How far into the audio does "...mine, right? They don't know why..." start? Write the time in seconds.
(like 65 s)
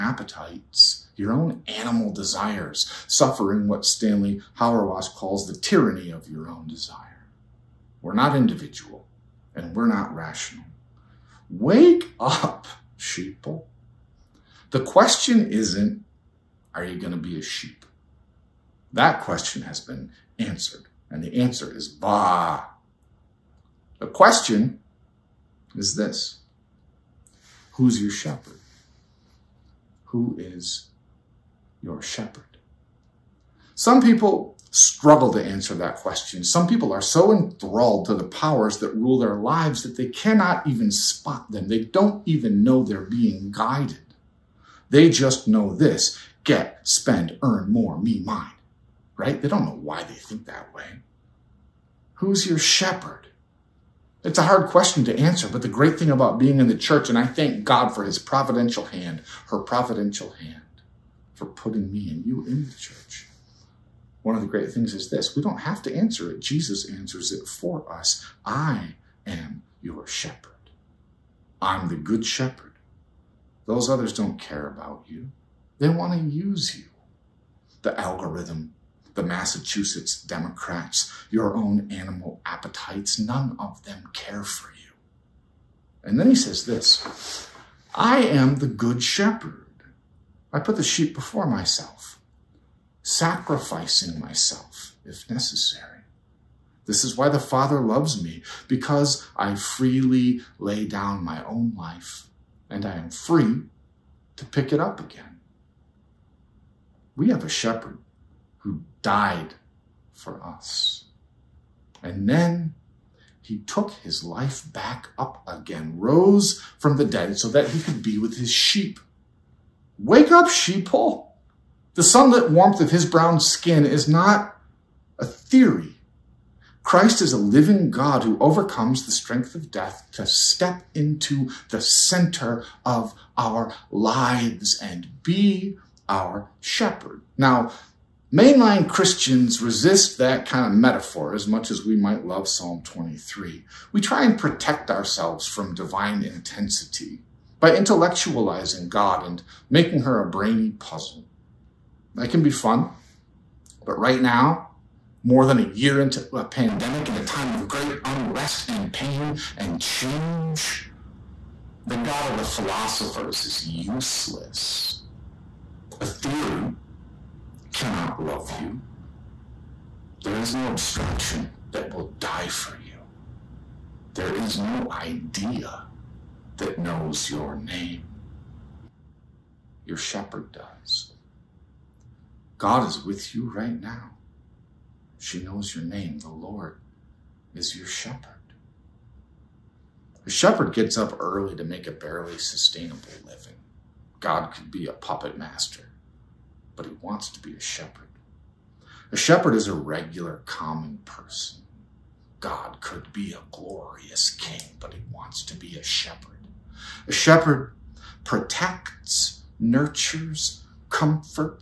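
48 s.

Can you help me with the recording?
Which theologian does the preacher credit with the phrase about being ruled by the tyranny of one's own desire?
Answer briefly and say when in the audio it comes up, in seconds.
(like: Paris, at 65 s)
Stanley Hauerwas, at 3 s.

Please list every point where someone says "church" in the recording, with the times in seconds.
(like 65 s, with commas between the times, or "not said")
56 s, 62 s.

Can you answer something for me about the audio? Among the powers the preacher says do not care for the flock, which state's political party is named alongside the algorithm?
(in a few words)
Massachusetts Democrats.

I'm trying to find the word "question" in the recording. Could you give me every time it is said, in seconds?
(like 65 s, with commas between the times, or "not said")
14 s, 19 s, 24 s, 35 s, 54 s.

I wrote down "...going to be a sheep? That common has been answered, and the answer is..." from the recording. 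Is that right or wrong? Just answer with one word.
wrong.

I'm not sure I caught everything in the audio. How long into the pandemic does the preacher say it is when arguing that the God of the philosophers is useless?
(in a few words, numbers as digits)
More than a year.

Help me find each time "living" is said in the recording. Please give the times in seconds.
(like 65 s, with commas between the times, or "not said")
127 s, 193 s.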